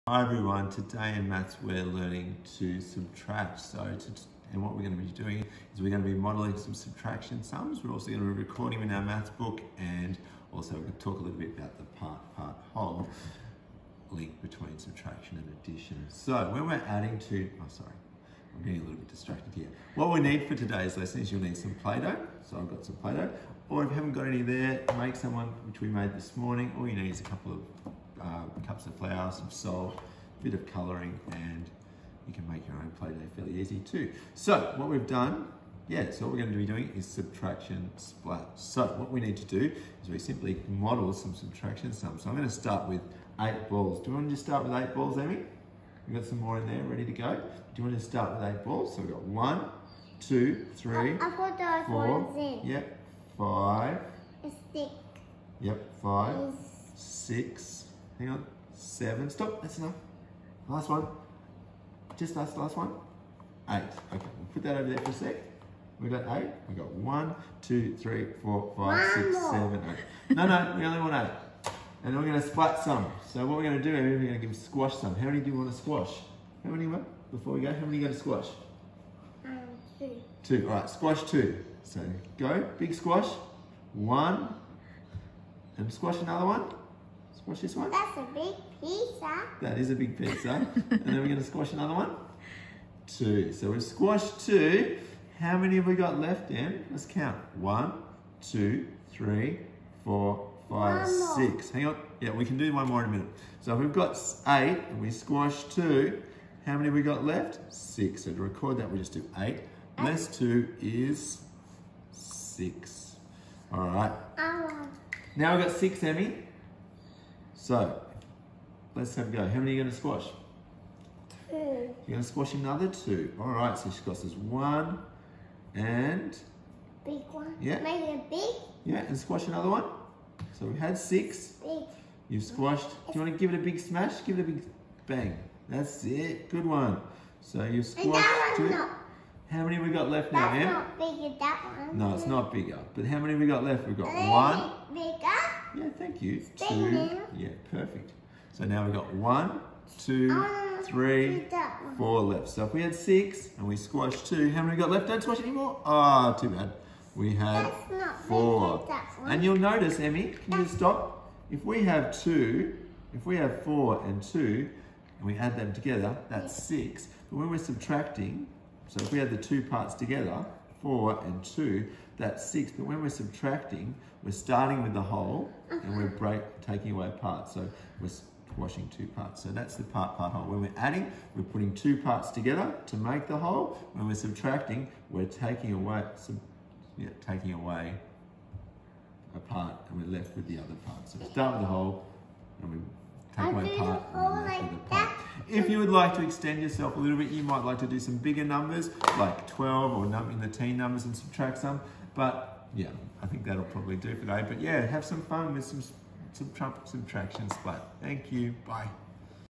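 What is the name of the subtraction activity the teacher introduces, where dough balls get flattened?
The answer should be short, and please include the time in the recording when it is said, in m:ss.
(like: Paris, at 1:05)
subtraction splat, at 0:37.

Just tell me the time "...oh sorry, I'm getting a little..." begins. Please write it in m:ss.
0:17.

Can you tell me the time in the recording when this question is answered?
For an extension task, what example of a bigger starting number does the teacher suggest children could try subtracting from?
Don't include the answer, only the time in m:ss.
3:19.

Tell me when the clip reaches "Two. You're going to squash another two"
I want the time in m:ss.
2:01.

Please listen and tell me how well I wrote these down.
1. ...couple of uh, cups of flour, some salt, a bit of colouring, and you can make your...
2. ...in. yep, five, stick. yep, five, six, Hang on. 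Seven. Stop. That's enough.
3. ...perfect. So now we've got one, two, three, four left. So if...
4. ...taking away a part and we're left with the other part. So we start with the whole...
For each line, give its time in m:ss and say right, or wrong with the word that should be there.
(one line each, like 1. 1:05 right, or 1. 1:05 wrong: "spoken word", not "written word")
1. 0:27 right
2. 0:52 right
3. 2:27 right
4. 3:07 right.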